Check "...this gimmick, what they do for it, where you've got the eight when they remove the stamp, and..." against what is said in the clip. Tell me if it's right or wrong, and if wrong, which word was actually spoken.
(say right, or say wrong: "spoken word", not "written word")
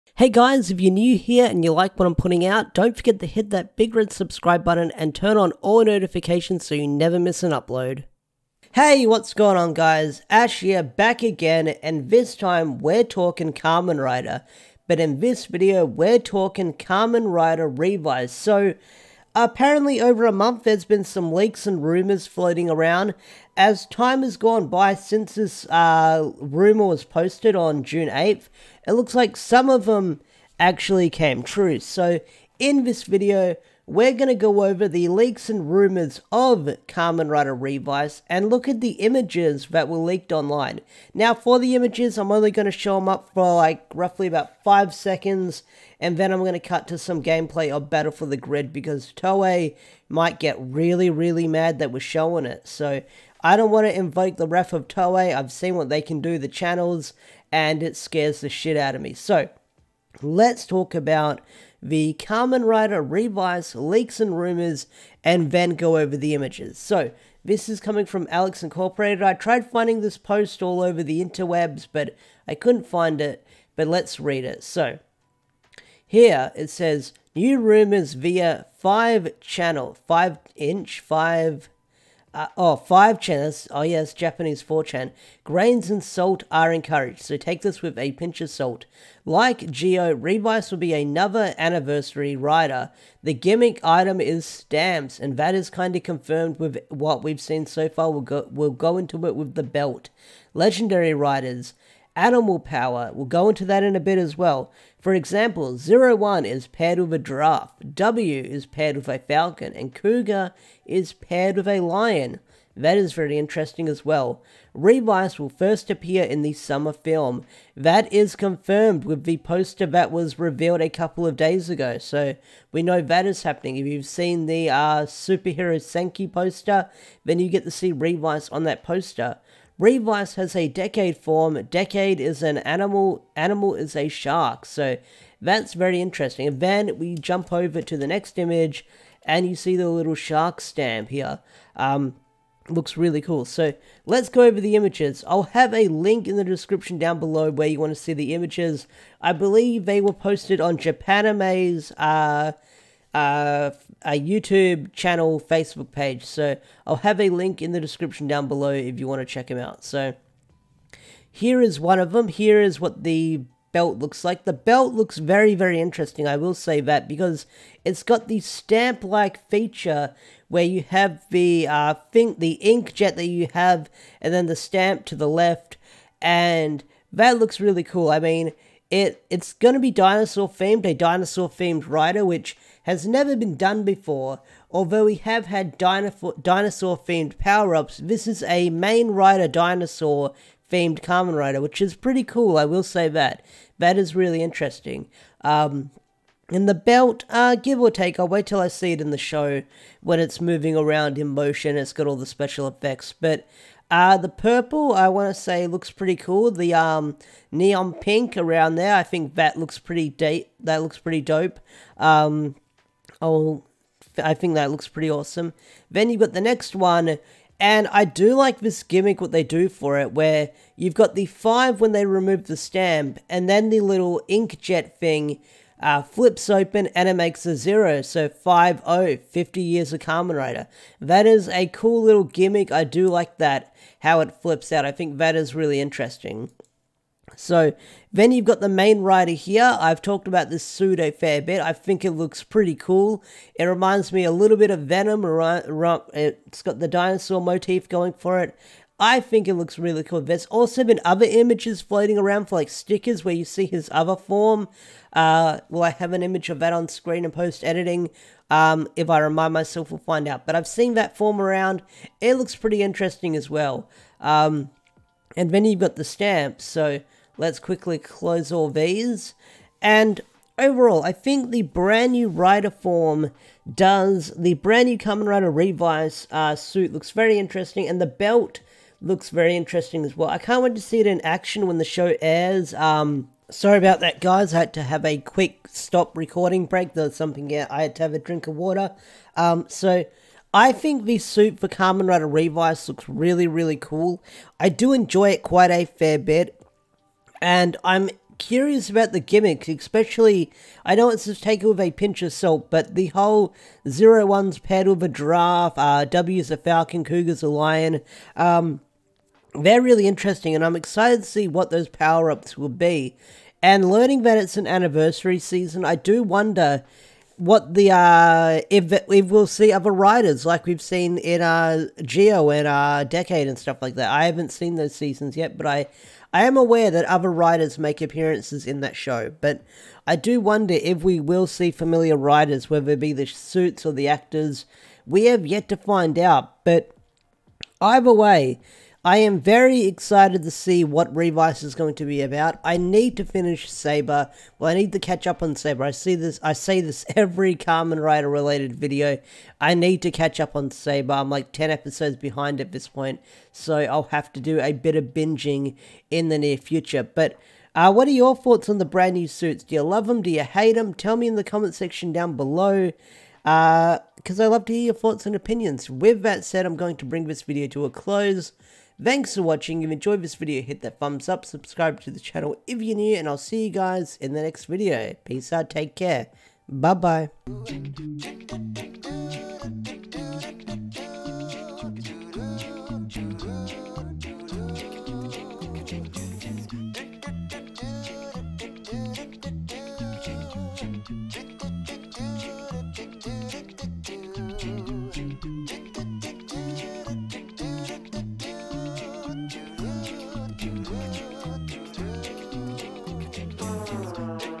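wrong: "five", not "eight".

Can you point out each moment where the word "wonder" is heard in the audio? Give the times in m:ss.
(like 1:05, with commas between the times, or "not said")
5:16, 5:30.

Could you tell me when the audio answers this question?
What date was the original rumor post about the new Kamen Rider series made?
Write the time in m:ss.
0:27.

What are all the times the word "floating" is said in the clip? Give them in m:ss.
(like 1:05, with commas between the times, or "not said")
0:22, 4:11.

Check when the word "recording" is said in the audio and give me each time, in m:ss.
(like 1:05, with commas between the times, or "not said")
4:46.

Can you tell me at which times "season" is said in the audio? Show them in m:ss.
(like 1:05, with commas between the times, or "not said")
5:15, 5:24.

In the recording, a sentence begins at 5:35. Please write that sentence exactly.
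We have yet to find out, but either way, I am very excited to see what Revice is going to be about.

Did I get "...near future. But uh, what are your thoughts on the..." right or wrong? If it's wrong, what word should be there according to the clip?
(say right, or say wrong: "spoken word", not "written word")
right.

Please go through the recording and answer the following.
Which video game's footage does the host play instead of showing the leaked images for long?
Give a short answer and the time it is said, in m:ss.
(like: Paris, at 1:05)
Battle for the Grid, at 0:47.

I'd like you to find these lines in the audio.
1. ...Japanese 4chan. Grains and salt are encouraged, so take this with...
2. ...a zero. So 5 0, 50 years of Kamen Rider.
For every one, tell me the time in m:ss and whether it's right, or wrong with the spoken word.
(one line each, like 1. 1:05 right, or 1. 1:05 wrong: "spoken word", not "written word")
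1. 1:24 right
2. 3:47 right.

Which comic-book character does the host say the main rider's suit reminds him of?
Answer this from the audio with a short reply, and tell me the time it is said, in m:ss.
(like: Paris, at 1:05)
Venom, at 4:04.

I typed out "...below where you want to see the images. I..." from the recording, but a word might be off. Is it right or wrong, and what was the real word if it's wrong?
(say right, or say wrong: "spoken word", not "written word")
right.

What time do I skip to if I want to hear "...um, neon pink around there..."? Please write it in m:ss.
3:26.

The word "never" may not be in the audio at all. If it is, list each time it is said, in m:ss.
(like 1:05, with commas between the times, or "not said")
0:06, 3:03.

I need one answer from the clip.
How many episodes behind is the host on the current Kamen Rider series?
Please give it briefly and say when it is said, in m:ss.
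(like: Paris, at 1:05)
10, at 5:51.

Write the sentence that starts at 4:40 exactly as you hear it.
I can't wait to see it in action when the show airs.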